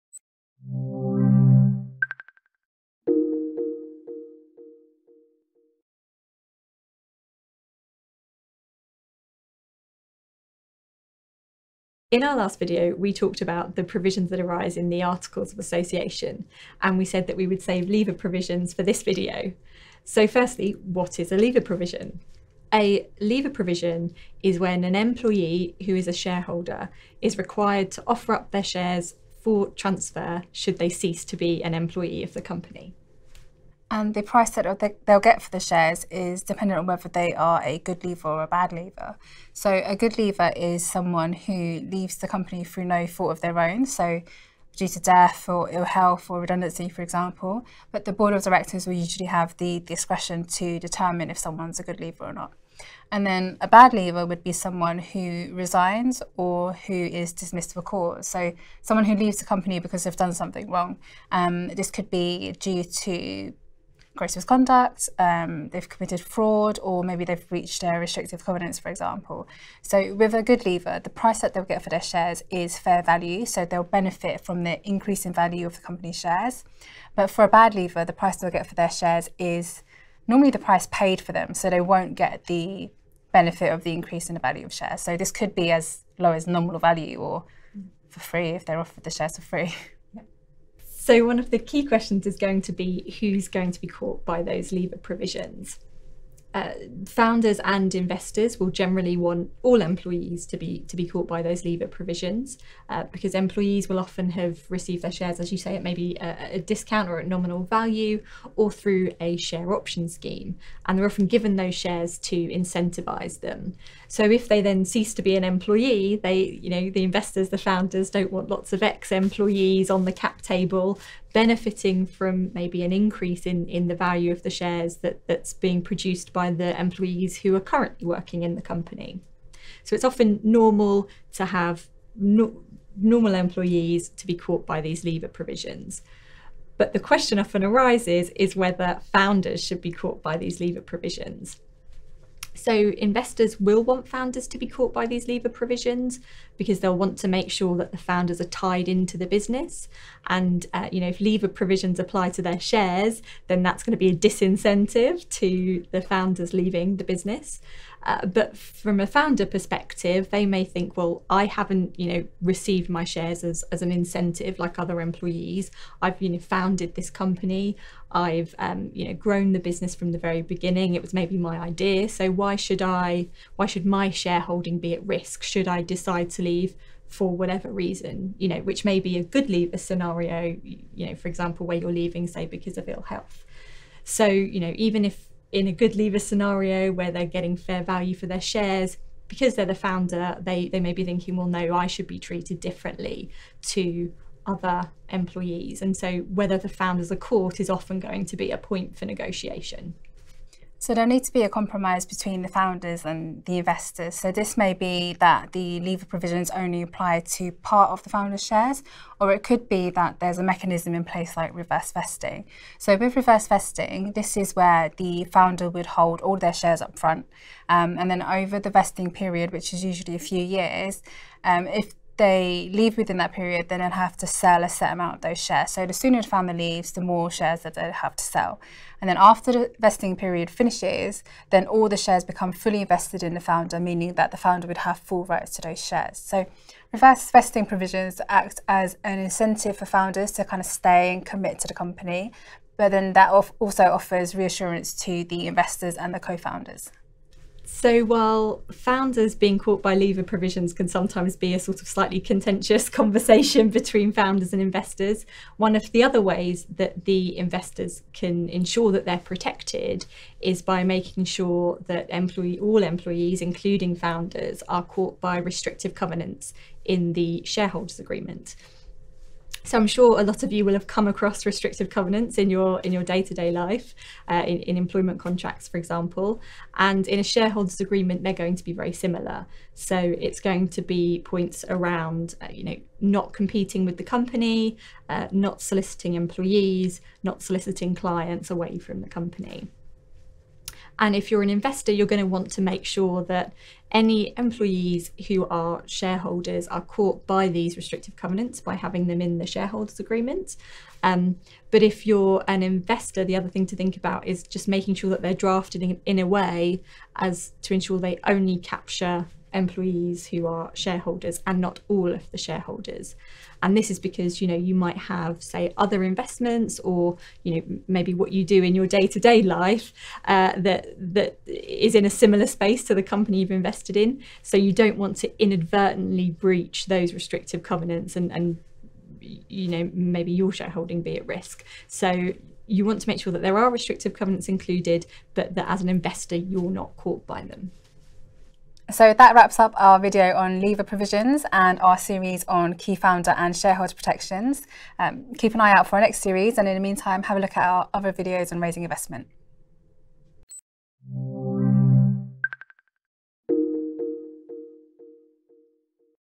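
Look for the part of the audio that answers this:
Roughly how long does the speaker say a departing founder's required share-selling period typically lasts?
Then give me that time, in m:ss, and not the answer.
3:40.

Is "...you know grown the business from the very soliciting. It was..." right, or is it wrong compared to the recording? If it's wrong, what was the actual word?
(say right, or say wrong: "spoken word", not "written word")
wrong: "beginning", not "soliciting".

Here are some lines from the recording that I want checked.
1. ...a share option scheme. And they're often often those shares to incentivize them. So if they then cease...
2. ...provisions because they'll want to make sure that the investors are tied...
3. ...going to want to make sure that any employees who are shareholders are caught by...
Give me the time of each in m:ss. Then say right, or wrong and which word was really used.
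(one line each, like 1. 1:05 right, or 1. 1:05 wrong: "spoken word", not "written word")
1. 1:49 wrong: "given", not "often"
2. 2:25 wrong: "founders", not "investors"
3. 4:52 right.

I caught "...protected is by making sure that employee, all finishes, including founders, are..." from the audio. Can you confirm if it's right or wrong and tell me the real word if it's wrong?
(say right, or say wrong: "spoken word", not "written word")
wrong: "employees", not "finishes".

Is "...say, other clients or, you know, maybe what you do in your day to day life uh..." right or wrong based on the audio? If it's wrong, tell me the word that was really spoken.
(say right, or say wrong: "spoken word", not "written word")
wrong: "investments", not "clients".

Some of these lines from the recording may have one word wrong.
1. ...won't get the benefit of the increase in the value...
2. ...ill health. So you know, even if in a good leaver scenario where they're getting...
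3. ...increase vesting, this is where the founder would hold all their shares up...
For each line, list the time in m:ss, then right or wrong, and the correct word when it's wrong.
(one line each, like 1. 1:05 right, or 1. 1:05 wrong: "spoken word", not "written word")
1. 1:21 right
2. 3:02 right
3. 3:33 wrong: "reverse", not "increase".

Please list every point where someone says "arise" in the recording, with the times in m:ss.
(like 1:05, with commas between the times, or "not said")
0:14, 2:17.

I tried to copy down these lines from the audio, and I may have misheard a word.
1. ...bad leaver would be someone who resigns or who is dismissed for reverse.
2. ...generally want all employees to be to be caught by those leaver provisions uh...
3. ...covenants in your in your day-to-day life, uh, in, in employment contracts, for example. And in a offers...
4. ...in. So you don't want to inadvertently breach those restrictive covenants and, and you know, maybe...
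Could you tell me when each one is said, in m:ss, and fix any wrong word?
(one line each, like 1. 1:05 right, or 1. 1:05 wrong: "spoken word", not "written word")
1. 0:53 wrong: "cause", not "reverse"
2. 1:38 right
3. 4:31 wrong: "shareholders", not "offers"
4. 5:23 right.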